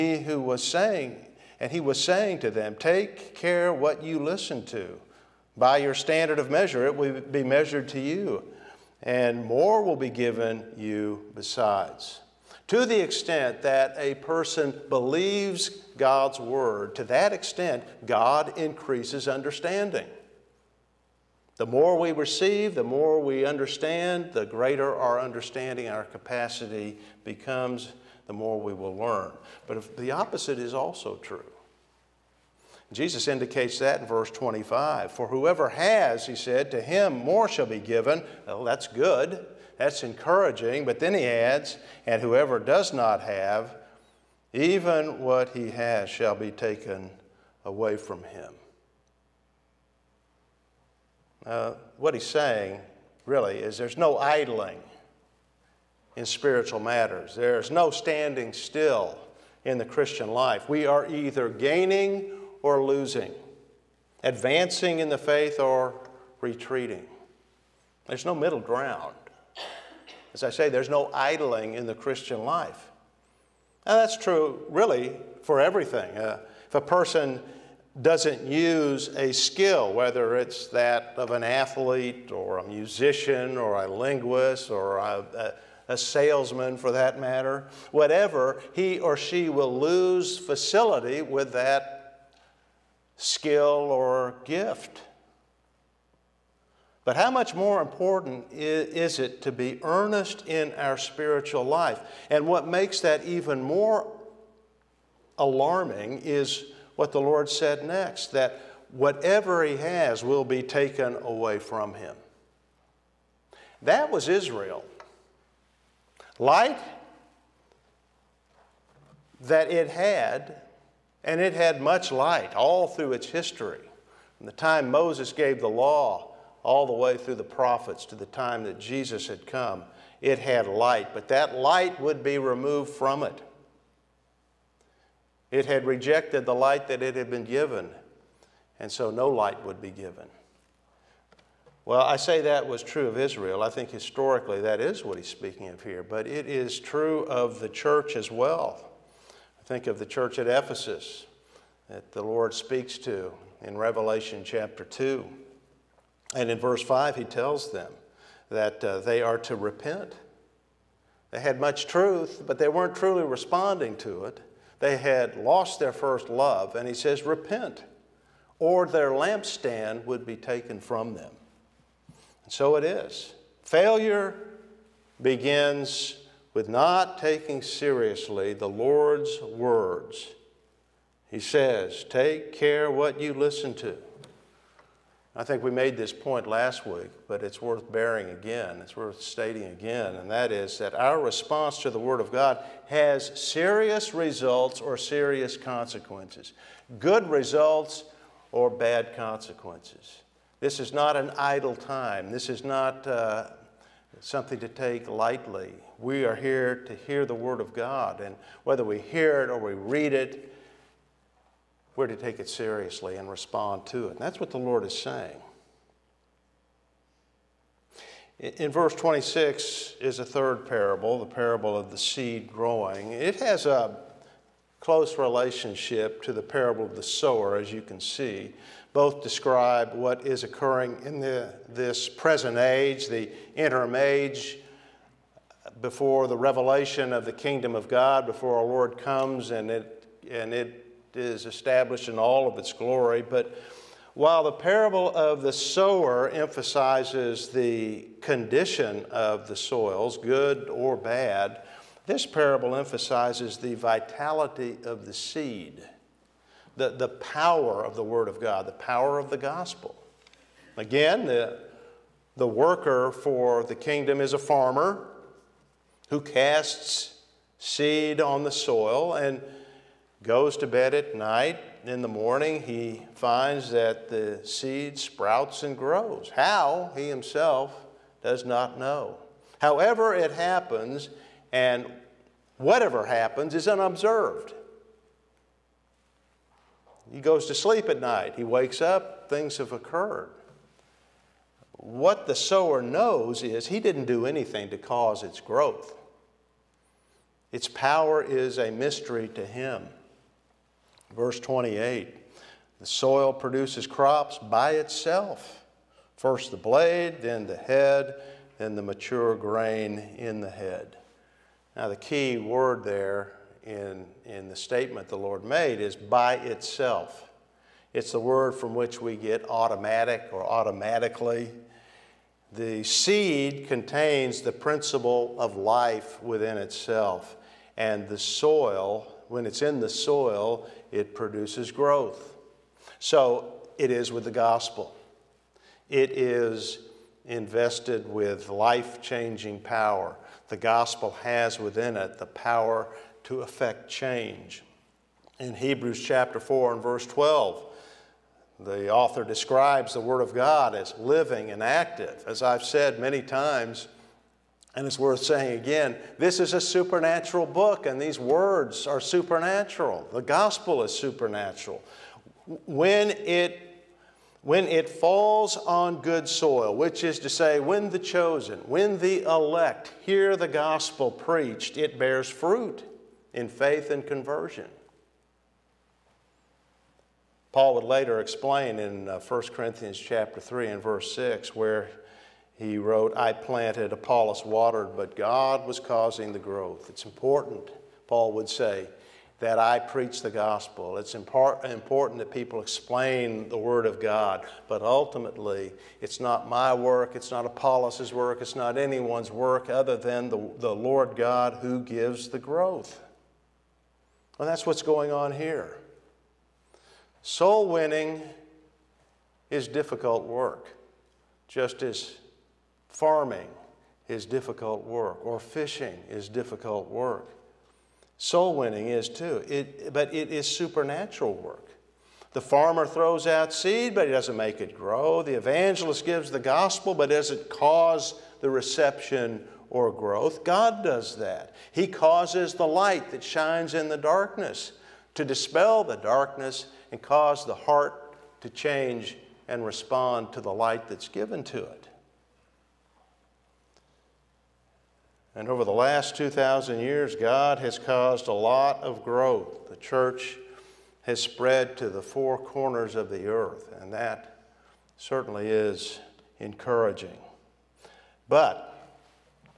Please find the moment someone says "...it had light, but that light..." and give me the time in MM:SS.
02:10.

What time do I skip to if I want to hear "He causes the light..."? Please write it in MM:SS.
07:11.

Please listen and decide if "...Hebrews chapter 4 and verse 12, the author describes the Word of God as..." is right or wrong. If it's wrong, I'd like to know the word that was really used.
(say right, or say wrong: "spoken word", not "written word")
right.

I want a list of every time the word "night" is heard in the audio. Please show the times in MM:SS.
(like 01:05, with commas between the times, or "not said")
04:31, 04:48.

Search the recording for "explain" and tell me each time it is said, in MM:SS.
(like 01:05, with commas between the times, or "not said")
06:18, 06:32.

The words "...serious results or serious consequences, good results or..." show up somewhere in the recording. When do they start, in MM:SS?
03:13.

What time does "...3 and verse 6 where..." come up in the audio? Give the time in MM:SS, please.
06:20.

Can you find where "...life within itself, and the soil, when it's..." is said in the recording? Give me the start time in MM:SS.
05:25.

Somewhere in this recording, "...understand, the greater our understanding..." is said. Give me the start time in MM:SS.
00:23.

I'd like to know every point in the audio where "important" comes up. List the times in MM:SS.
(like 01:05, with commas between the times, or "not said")
01:37, 06:27, 06:31.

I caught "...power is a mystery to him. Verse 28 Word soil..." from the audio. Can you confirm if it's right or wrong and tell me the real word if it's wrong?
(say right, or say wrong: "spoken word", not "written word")
wrong: "The", not "Word".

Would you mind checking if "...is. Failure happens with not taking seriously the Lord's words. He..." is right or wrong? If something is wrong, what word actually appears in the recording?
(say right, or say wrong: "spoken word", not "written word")
wrong: "begins", not "happens".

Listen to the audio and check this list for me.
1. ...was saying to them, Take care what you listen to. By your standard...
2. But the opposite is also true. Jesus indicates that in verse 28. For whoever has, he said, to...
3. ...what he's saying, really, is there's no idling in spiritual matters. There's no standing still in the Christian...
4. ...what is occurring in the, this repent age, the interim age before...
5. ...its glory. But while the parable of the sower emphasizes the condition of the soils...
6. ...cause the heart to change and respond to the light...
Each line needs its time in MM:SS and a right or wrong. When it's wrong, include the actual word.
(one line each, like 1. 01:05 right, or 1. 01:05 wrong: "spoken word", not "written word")
1. 00:01 right
2. 00:29 wrong: "25", not "28"
3. 00:51 right
4. 03:49 wrong: "present", not "repent"
5. 04:02 right
6. 07:17 right.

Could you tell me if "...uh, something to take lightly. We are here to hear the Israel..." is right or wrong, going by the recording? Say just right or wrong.
wrong.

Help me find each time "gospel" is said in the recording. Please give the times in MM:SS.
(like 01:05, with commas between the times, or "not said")
04:19, 05:34, 05:40, 06:00, 06:10, 06:30, 07:06.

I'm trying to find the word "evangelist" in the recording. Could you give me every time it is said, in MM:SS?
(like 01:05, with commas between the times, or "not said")
07:05.